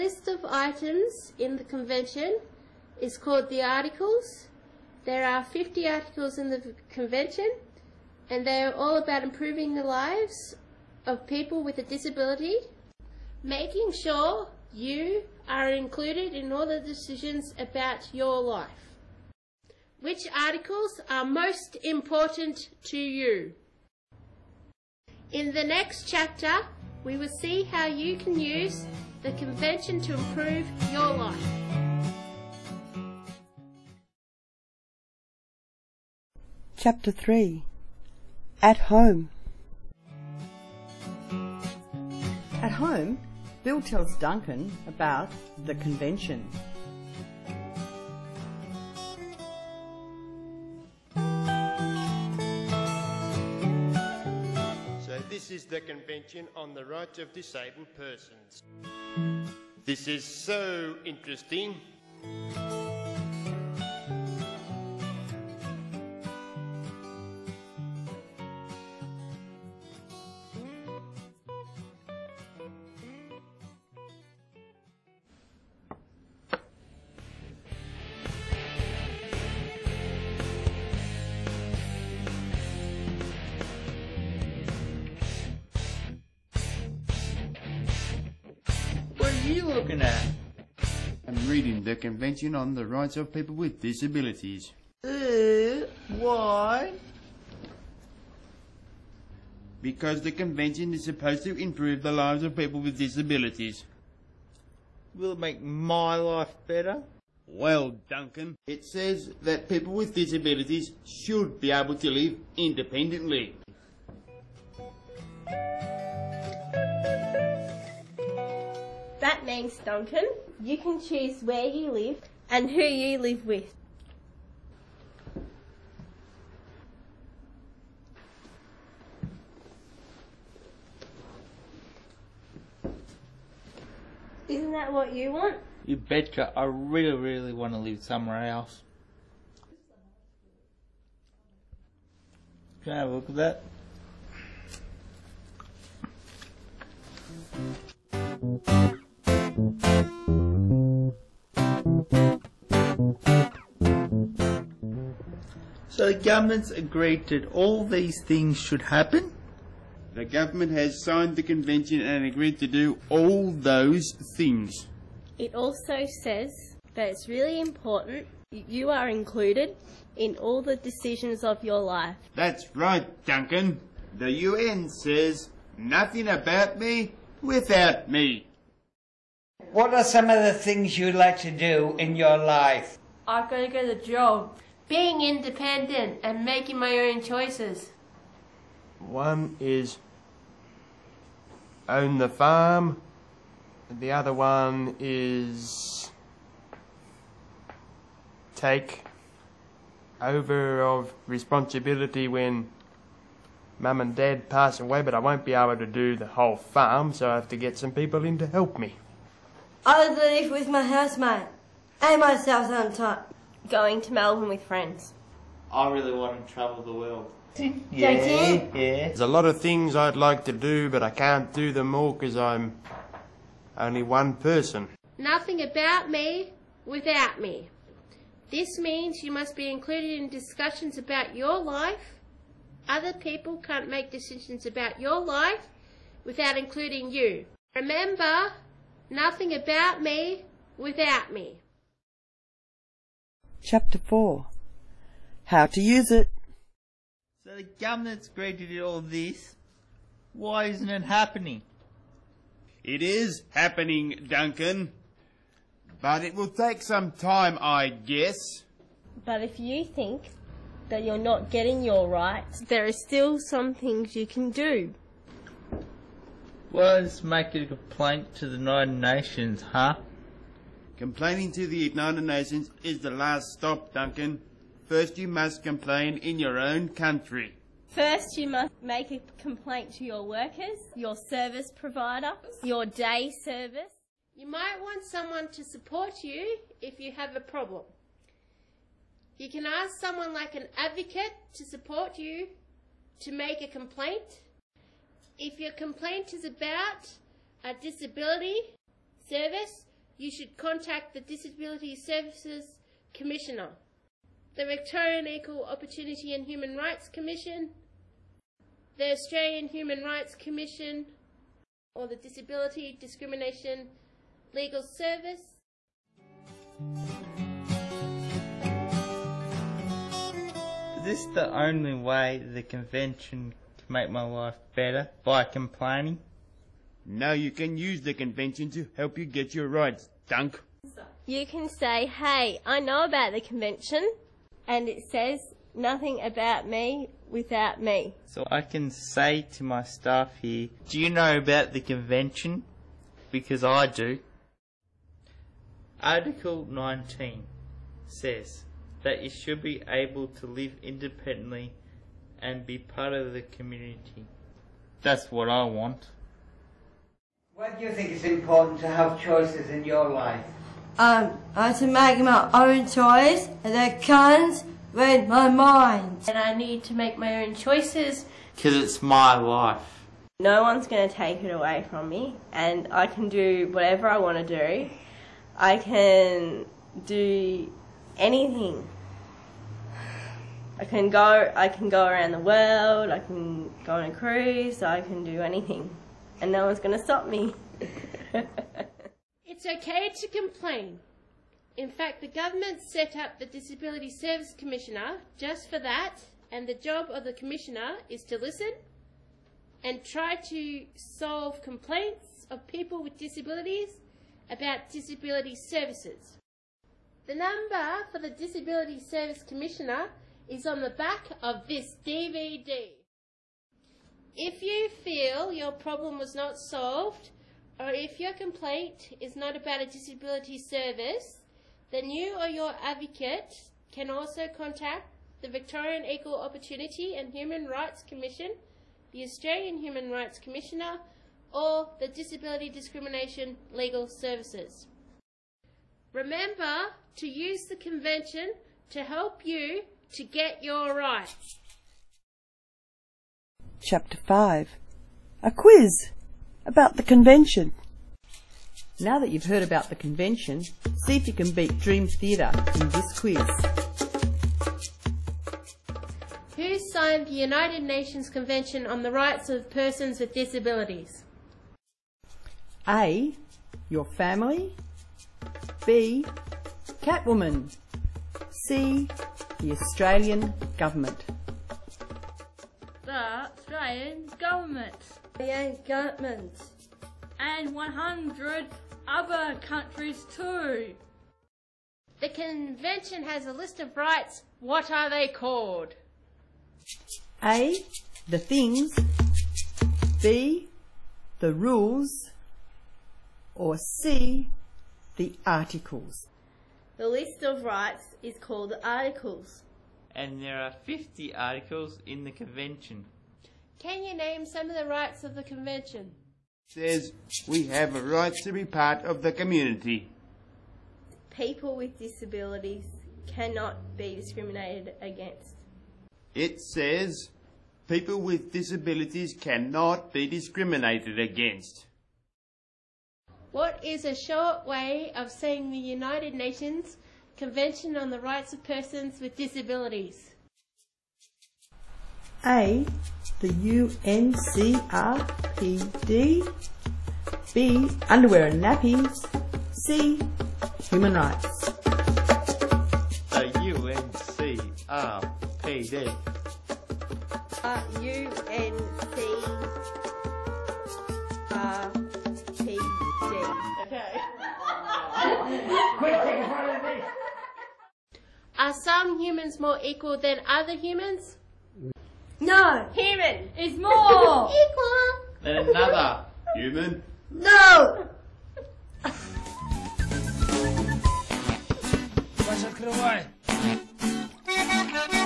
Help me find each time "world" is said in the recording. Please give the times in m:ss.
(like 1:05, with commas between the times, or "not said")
3:36, 6:22.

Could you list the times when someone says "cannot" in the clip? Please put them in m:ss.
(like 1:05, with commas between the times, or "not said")
8:33, 8:39.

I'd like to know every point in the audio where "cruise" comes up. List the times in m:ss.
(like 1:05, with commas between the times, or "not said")
6:24.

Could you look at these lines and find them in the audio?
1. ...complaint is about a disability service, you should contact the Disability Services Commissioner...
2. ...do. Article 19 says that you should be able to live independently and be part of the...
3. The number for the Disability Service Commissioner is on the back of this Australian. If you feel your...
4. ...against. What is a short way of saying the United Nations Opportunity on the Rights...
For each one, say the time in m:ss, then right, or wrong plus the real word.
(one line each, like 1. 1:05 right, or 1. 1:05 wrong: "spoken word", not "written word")
1. 4:55 right
2. 5:43 right
3. 6:47 wrong: "DVD", not "Australian"
4. 8:41 wrong: "Convention", not "Opportunity".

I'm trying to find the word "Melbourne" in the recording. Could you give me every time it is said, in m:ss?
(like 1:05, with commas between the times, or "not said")
3:34.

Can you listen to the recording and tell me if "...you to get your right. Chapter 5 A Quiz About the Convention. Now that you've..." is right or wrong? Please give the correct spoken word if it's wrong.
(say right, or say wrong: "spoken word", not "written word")
right.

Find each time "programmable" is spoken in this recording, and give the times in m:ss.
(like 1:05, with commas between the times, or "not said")
not said.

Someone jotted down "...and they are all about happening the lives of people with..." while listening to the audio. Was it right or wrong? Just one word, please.
wrong.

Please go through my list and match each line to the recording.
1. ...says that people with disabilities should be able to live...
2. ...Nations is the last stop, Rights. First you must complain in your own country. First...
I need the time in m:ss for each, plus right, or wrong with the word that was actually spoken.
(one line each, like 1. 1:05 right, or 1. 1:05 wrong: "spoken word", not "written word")
1. 1:48 right
2. 4:32 wrong: "Duncan", not "Rights".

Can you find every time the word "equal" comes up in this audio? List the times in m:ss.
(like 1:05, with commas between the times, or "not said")
5:05, 7:06, 9:19, 9:24.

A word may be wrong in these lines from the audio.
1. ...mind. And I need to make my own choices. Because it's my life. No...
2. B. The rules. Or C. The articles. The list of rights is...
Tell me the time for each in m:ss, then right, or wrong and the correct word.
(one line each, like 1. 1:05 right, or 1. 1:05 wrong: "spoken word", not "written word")
1. 6:05 right
2. 8:10 right.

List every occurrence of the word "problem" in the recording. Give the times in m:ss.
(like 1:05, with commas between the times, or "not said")
4:47, 6:55.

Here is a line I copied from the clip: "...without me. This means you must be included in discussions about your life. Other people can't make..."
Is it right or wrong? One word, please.
right.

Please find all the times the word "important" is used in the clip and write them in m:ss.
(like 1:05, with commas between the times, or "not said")
0:21, 2:47, 5:58.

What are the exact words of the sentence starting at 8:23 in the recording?
Can you name some of the rights of the Convention?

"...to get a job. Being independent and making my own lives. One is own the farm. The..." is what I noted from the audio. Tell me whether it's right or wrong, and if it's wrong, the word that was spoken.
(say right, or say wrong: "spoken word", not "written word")
wrong: "choices", not "lives".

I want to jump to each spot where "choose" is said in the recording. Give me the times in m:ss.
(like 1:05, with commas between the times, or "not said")
2:00.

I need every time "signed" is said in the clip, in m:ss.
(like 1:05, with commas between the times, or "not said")
2:41, 7:36.